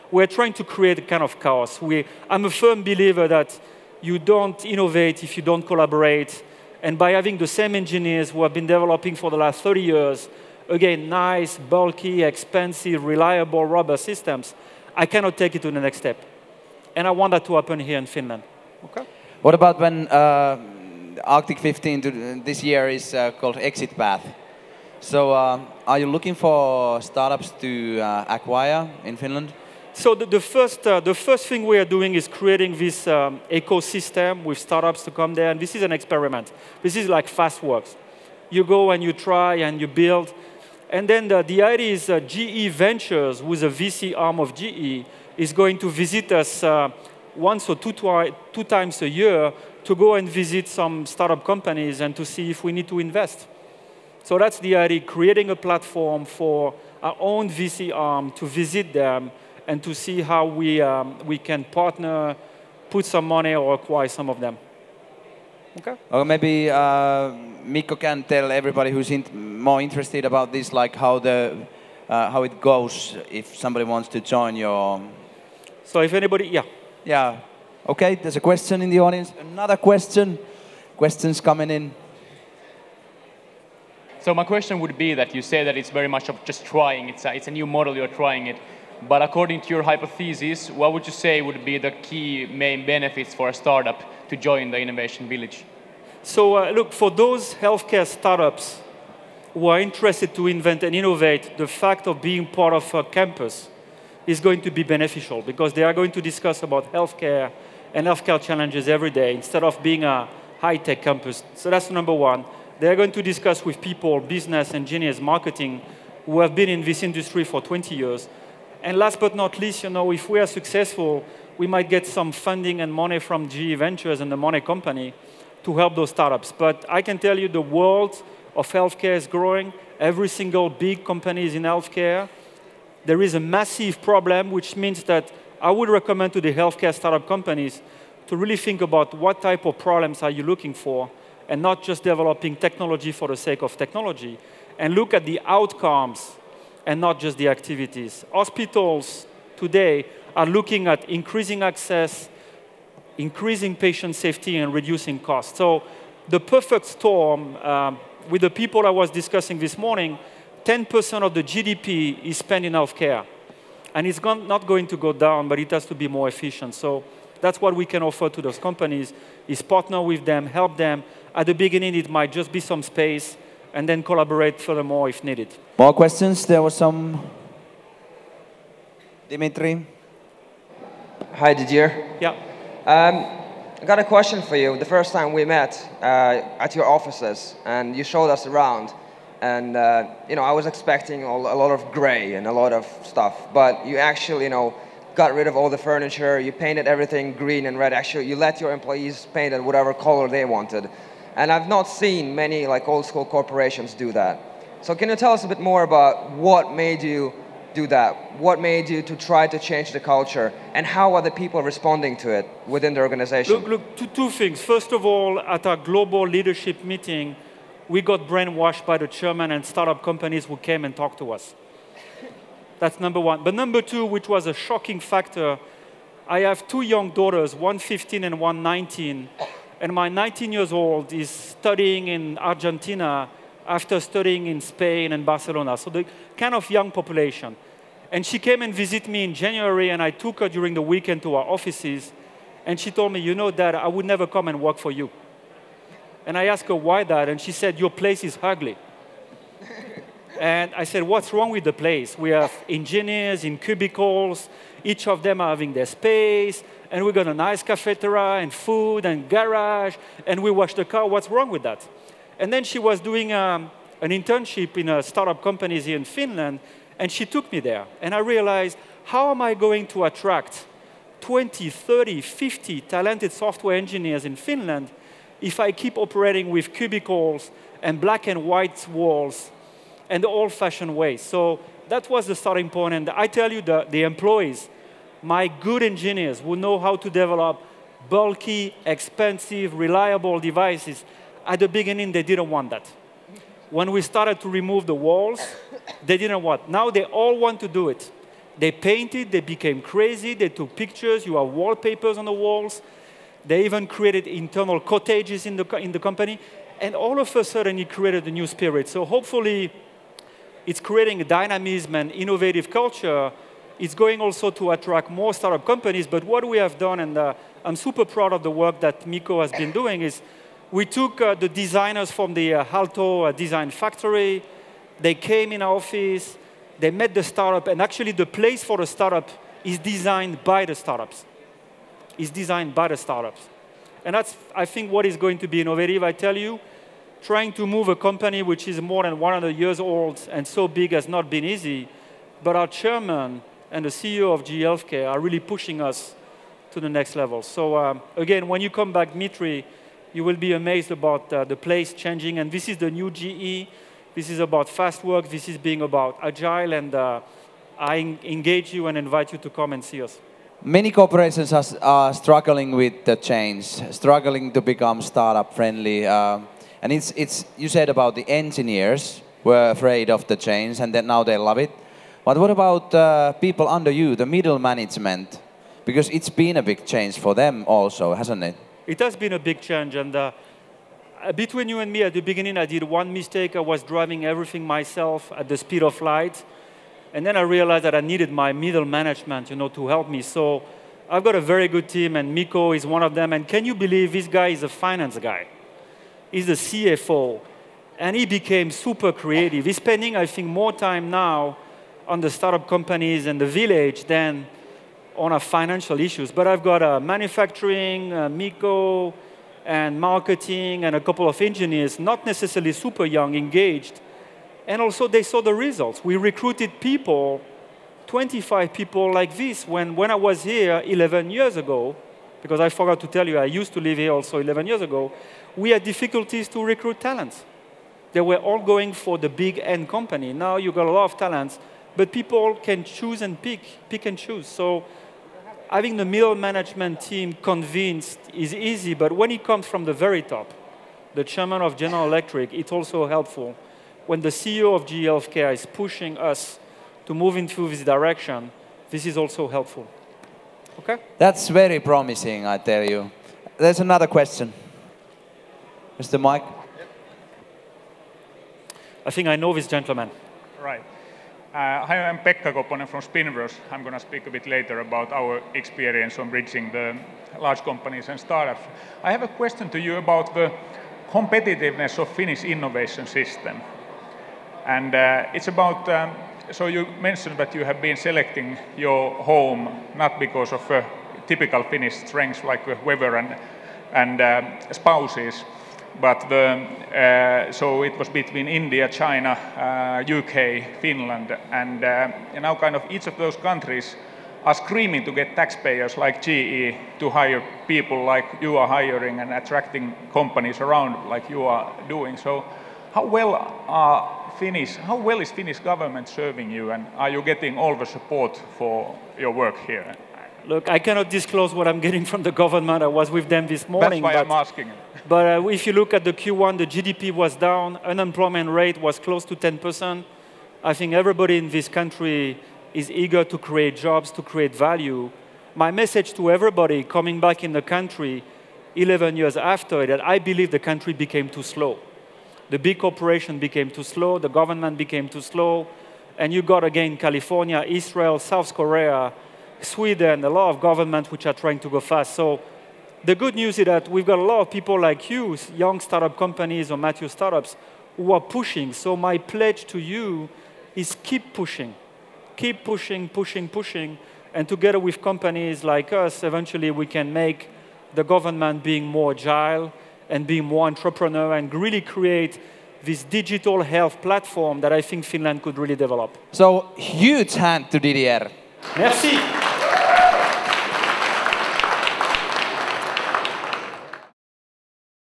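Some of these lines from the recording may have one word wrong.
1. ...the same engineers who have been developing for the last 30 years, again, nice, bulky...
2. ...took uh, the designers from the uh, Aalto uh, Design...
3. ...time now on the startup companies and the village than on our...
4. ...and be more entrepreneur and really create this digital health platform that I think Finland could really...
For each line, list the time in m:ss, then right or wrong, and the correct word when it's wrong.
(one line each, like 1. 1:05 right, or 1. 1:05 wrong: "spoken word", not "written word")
1. 0:07 right
2. 5:20 right
3. 6:40 right
4. 9:20 right.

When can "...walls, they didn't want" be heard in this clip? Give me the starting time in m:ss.
4:54.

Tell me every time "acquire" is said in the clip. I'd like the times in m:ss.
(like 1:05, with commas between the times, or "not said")
0:28, 1:03.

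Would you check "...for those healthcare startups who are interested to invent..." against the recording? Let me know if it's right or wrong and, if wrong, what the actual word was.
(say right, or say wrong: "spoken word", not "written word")
right.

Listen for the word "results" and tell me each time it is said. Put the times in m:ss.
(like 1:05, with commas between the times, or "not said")
6:55.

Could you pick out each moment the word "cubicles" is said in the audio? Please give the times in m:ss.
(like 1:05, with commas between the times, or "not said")
4:13, 4:36.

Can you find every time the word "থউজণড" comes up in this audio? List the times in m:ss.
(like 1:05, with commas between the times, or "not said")
not said.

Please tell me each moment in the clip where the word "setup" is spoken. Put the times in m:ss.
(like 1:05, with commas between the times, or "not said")
not said.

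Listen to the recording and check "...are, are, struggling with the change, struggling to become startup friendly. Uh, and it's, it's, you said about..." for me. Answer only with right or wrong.
right.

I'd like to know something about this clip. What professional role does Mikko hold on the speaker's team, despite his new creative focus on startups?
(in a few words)
CFO.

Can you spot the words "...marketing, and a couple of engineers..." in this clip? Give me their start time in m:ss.
6:50.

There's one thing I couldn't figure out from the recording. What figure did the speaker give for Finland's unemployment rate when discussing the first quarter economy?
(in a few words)
close to 10%.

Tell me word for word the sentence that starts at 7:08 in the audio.
They were all going for the big end company.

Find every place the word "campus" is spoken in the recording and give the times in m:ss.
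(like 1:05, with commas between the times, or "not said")
1:43, 1:51.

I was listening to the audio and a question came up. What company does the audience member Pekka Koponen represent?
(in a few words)
Spinverse.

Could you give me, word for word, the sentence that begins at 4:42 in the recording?
And I tell you, the, the employees, my good engineers will know how to develop bulky, expensive, reliable devices.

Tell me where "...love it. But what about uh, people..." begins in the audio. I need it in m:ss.
6:11.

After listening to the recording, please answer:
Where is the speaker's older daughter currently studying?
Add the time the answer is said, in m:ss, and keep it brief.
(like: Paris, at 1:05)
Argentina, at 3:52.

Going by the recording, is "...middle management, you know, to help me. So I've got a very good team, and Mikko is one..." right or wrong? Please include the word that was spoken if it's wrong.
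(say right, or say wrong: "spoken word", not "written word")
right.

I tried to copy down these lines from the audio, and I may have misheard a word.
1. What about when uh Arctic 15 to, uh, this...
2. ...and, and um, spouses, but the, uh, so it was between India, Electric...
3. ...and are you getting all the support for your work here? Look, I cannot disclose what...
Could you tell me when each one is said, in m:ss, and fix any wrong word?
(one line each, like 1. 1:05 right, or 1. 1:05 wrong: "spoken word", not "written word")
1. 0:19 right
2. 8:03 wrong: "China", not "Electric"
3. 8:26 right.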